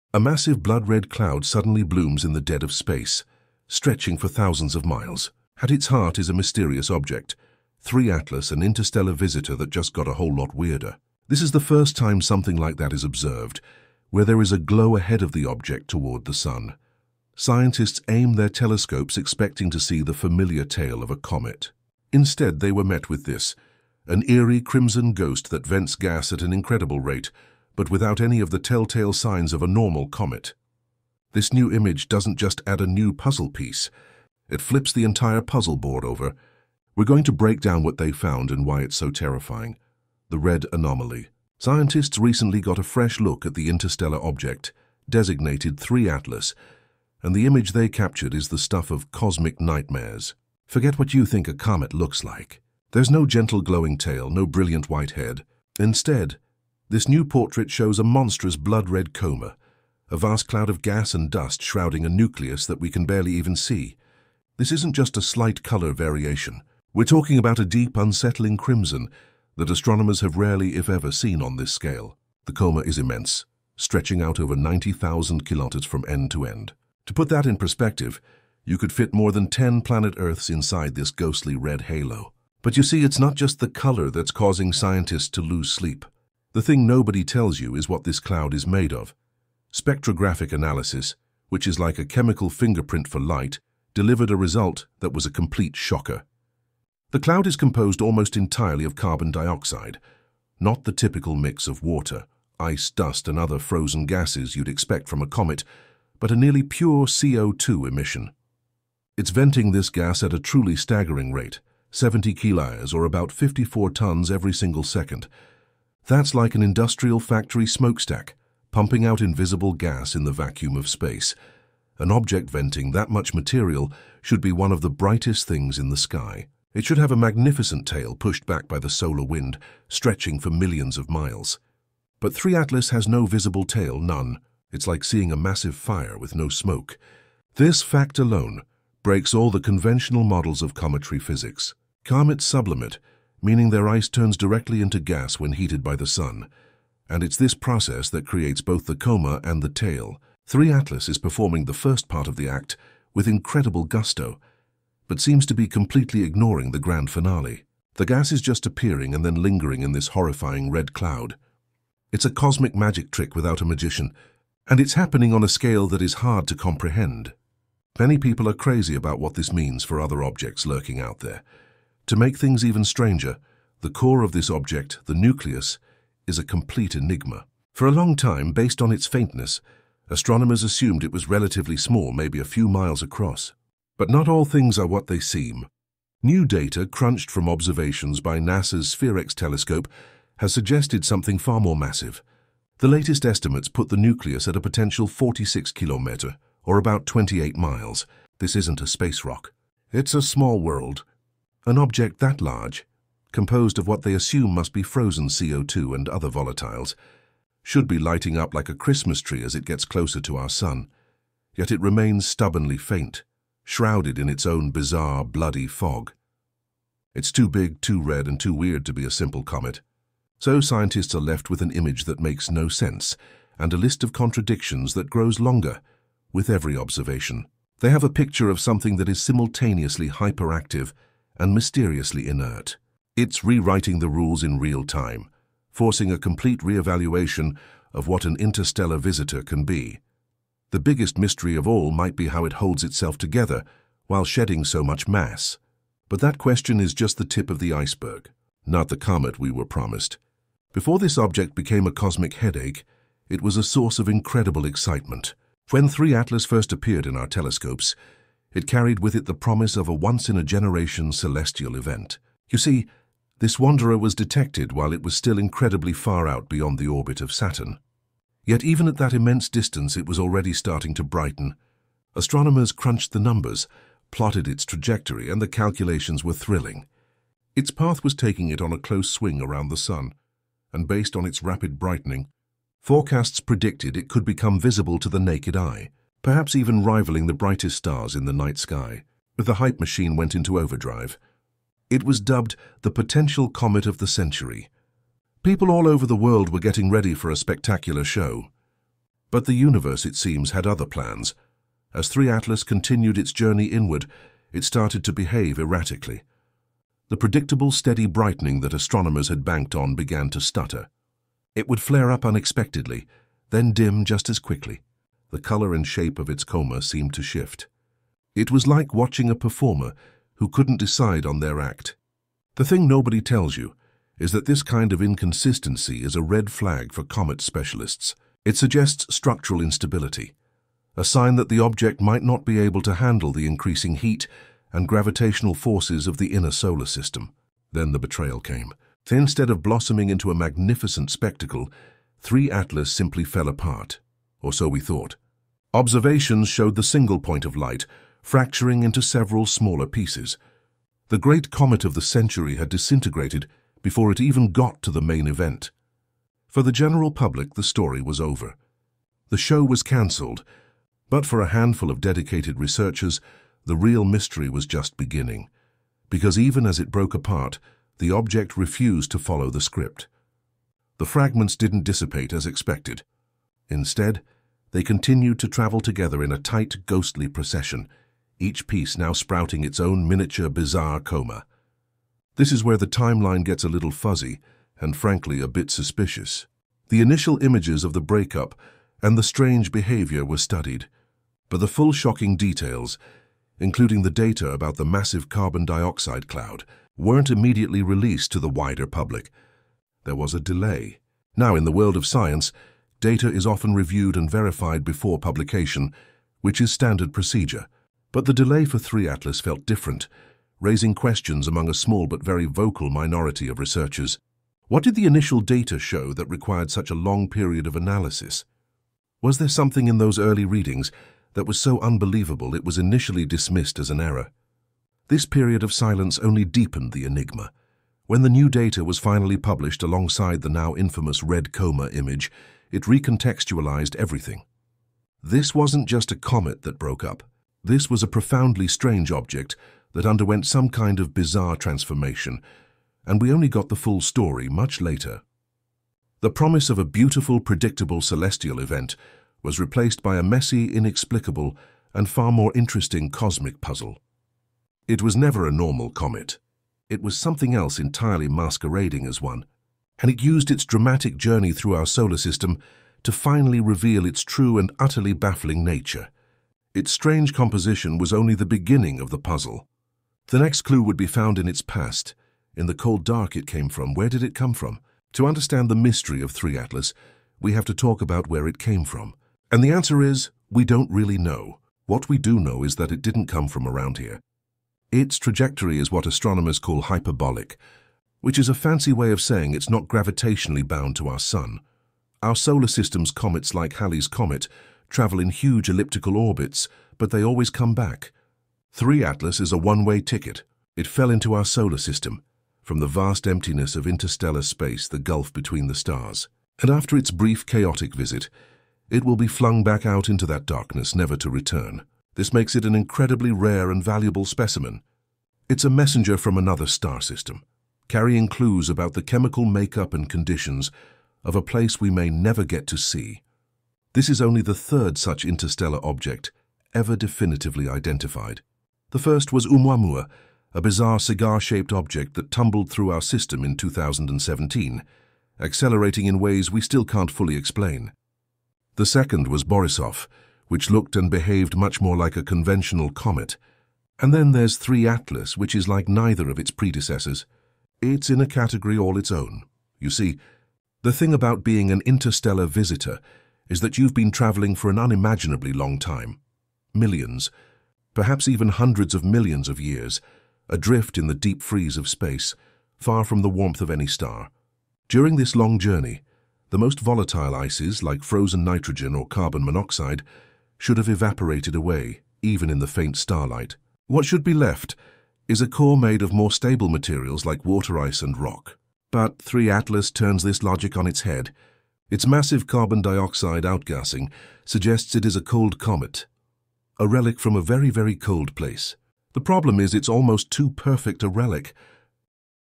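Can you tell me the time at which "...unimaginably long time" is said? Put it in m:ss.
9:14.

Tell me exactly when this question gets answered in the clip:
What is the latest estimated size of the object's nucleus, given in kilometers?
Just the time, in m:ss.
3:15.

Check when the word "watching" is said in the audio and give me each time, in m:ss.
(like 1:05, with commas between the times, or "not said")
5:18.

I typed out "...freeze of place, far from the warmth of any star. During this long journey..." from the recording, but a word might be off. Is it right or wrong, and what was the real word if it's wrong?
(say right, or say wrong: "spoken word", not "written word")
wrong: "space", not "place".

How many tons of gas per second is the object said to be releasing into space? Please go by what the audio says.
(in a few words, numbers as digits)
54 tons.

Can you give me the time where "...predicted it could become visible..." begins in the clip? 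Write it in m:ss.
4:43.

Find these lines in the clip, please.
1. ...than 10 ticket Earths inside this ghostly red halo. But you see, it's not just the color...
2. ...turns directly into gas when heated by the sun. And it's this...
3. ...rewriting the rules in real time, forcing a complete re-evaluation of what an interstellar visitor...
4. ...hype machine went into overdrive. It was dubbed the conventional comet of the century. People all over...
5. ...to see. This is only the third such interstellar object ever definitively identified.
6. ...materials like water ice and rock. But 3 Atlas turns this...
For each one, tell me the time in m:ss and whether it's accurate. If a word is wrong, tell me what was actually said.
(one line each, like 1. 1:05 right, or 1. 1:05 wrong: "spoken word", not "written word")
1. 1:19 wrong: "planet", not "ticket"
2. 2:24 right
3. 3:53 right
4. 4:49 wrong: "potential", not "conventional"
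5. 8:42 right
6. 9:36 right.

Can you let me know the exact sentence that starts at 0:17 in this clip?
Scientists aim their telescopes expecting to see the familiar tail of a comet.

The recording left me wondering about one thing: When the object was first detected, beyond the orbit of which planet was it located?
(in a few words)
Saturn.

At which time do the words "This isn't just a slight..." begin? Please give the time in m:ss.
1:04.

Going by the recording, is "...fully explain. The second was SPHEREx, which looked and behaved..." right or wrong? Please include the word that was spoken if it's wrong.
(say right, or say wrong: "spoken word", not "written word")
wrong: "Borisov", not "SPHEREx".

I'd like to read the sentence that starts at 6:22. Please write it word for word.
This is where the timeline gets a little fuzzy and, frankly, a bit suspicious.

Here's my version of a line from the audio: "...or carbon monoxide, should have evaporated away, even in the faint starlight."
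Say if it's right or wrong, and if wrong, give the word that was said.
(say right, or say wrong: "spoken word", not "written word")
right.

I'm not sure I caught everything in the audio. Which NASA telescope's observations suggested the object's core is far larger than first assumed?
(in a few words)
SPHEREx.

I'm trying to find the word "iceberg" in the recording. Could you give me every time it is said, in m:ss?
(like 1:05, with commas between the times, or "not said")
4:07.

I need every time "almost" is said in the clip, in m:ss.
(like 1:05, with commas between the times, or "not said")
1:38, 9:49.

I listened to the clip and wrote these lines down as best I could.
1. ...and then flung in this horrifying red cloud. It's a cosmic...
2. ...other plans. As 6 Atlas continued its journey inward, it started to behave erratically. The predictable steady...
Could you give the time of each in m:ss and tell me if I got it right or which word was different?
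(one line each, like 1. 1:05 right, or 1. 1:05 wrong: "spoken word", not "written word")
1. 2:39 wrong: "lingering", not "flung"
2. 5:00 wrong: "3", not "6".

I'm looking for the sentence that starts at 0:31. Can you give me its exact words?
This new image doesn't just add a new puzzle piece, it flips the entire puzzle board over.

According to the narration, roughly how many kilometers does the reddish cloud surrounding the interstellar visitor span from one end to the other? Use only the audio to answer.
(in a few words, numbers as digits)
90,000 kilometers.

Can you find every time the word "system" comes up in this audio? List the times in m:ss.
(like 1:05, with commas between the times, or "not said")
5:36, 7:42, 8:12, 8:21, 8:37, 8:53.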